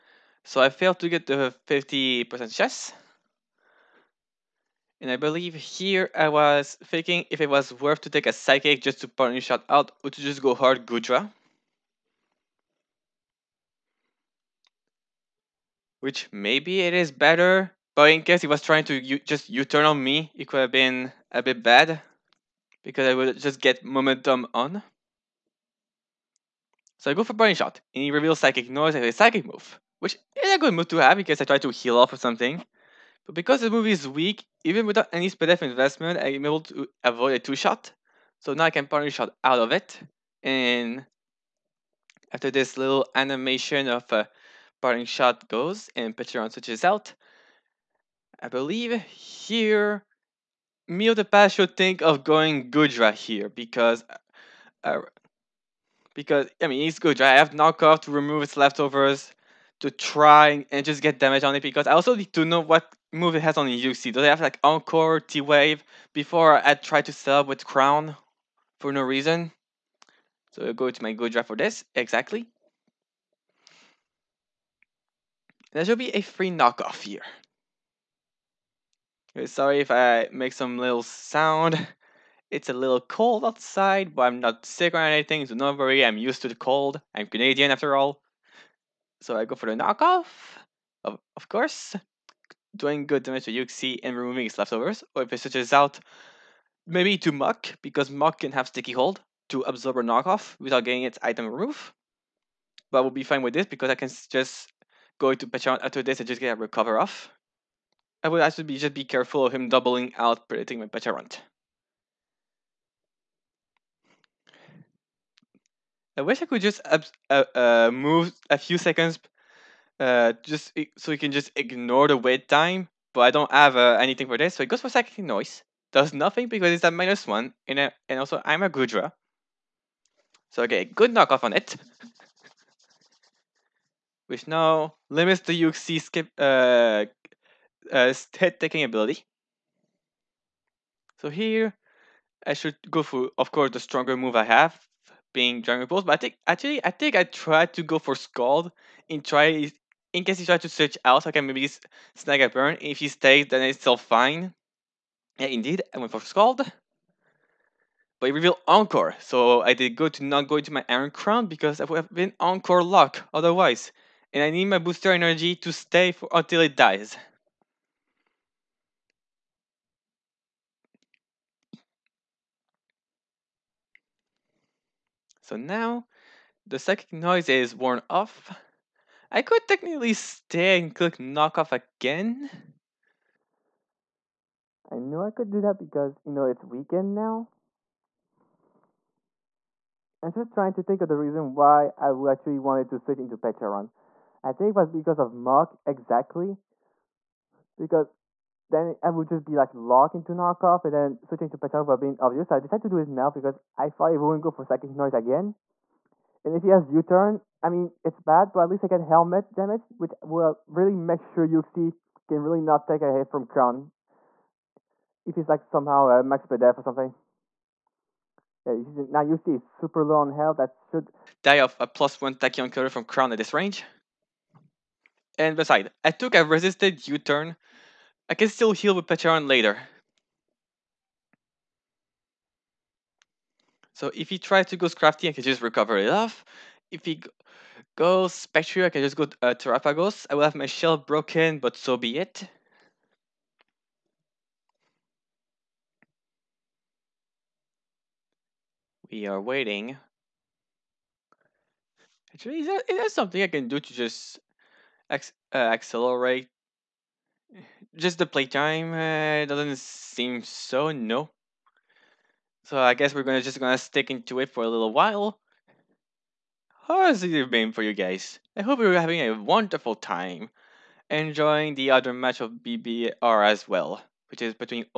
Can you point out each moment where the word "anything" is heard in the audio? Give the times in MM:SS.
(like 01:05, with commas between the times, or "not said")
01:24, 02:03.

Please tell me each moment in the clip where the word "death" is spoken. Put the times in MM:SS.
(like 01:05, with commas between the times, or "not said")
00:35, 03:36.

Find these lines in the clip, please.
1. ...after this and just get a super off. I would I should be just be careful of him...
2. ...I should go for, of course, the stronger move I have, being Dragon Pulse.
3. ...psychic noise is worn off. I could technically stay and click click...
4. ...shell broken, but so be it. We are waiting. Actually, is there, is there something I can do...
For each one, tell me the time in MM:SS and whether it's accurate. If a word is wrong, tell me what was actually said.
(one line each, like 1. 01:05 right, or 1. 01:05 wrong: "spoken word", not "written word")
1. 01:45 wrong: "recover", not "super"
2. 02:22 right
3. 02:56 wrong: "knock", not "click"
4. 04:00 right.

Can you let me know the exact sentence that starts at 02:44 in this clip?
And I need my booster energy to stay for, until it dies.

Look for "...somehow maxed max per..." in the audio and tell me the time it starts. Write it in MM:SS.
03:35.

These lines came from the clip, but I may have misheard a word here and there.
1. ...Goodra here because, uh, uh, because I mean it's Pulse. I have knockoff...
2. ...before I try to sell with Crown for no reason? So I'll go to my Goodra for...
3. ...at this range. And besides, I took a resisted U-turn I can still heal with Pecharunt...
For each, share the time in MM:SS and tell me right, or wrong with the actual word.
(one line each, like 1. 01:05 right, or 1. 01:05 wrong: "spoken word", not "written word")
1. 00:52 wrong: "Goodra", not "Pulse"
2. 01:06 right
3. 03:43 right.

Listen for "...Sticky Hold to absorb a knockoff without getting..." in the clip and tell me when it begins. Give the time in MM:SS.
01:38.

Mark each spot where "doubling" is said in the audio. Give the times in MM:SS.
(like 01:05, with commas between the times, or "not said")
01:49.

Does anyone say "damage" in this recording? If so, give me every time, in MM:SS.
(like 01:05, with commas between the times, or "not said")
01:01, 01:33, 03:29.